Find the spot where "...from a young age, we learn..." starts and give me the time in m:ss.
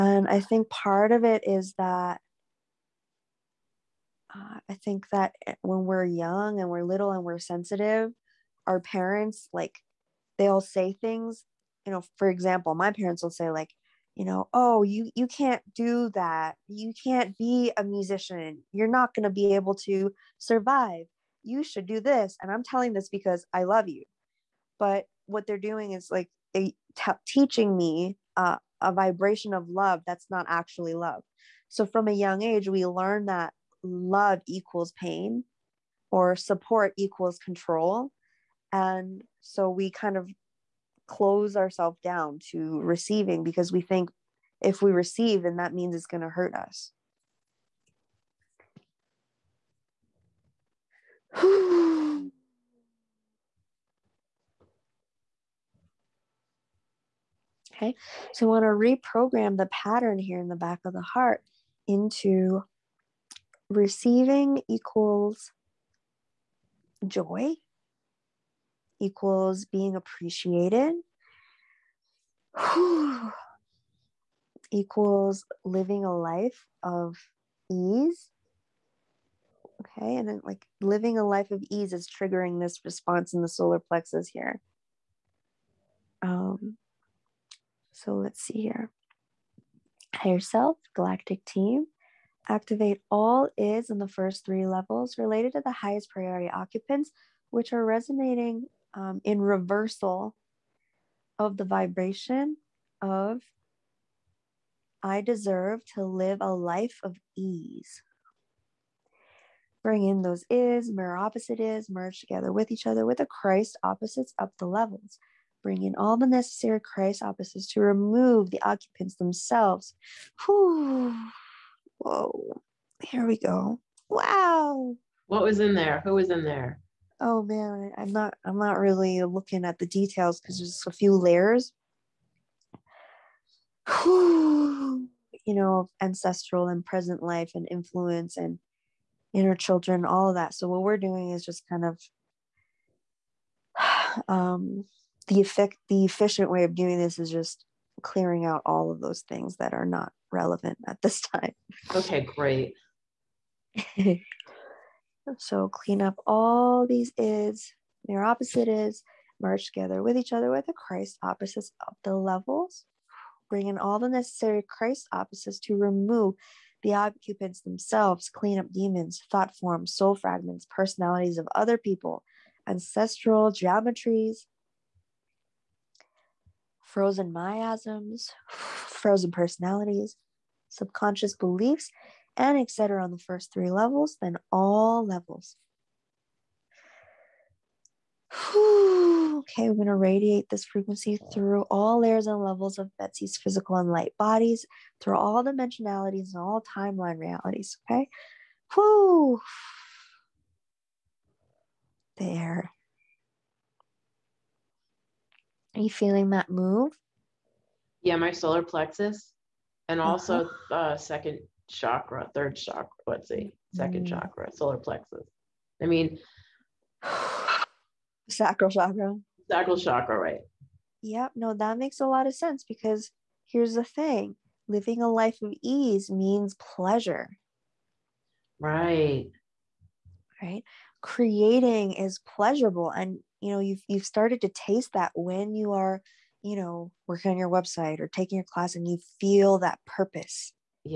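0:31.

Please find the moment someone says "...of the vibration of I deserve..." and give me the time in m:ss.
1:41.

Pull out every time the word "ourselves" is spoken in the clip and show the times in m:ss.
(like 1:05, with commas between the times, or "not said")
0:41.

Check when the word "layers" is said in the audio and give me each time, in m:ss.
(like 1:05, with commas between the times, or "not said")
2:11, 3:11.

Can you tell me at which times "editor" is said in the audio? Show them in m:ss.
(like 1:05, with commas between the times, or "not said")
not said.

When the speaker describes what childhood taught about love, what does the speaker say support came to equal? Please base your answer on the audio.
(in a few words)
Control.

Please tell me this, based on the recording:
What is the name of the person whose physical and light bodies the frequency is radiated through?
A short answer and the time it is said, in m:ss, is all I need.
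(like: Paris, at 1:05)
Betsy, at 3:12.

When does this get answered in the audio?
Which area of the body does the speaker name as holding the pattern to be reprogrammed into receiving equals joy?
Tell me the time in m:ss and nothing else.
1:00.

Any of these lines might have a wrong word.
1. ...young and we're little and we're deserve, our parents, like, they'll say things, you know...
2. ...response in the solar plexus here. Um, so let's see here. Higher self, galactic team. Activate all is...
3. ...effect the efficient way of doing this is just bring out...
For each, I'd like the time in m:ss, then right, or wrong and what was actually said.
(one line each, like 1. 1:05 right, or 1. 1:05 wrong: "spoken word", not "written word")
1. 0:06 wrong: "sensitive", not "deserve"
2. 1:22 right
3. 2:25 wrong: "clearing", not "bring".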